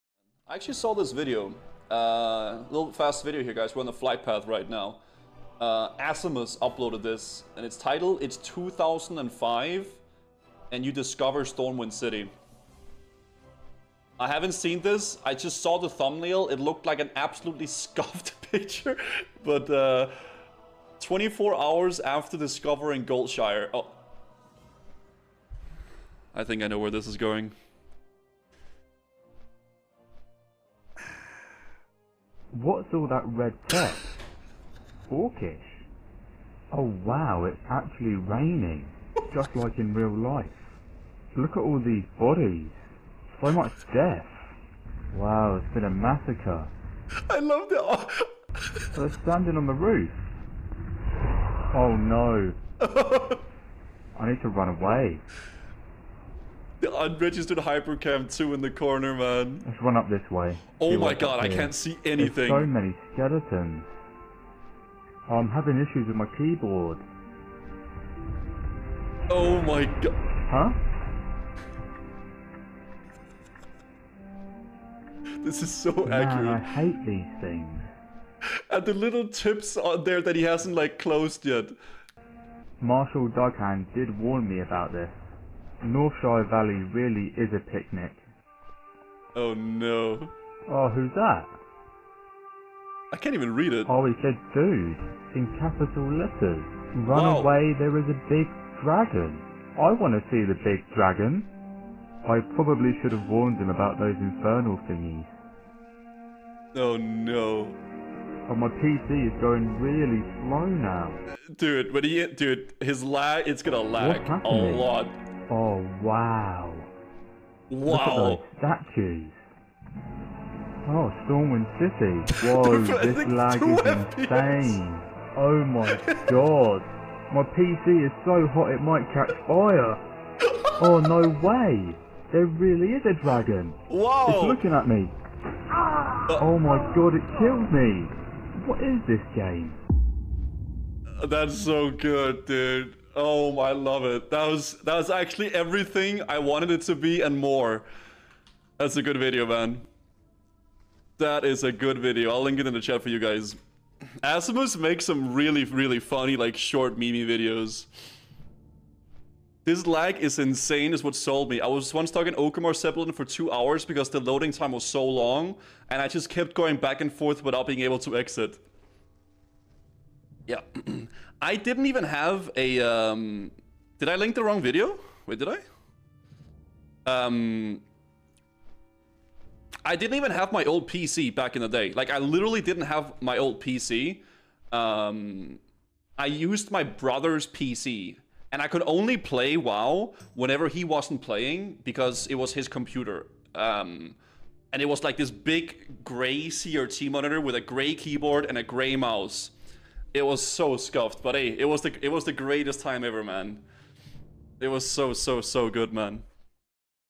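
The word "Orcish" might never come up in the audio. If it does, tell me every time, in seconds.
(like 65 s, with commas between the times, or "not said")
35 s.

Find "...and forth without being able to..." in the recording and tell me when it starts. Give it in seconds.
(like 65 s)
167 s.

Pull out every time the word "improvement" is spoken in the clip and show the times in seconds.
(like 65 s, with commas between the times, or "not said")
not said.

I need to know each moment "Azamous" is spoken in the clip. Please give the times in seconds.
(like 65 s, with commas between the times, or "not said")
5 s, 154 s.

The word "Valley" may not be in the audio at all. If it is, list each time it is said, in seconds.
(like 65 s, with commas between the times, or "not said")
86 s.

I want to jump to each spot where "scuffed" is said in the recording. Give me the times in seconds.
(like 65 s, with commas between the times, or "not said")
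17 s, 200 s.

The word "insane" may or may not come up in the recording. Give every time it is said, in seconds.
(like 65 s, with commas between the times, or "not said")
124 s, 160 s.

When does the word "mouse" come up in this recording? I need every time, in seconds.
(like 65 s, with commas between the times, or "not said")
198 s.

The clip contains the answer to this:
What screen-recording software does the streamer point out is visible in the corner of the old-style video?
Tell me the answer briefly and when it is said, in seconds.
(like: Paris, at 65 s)
Unregistered Hypercam 2, at 56 s.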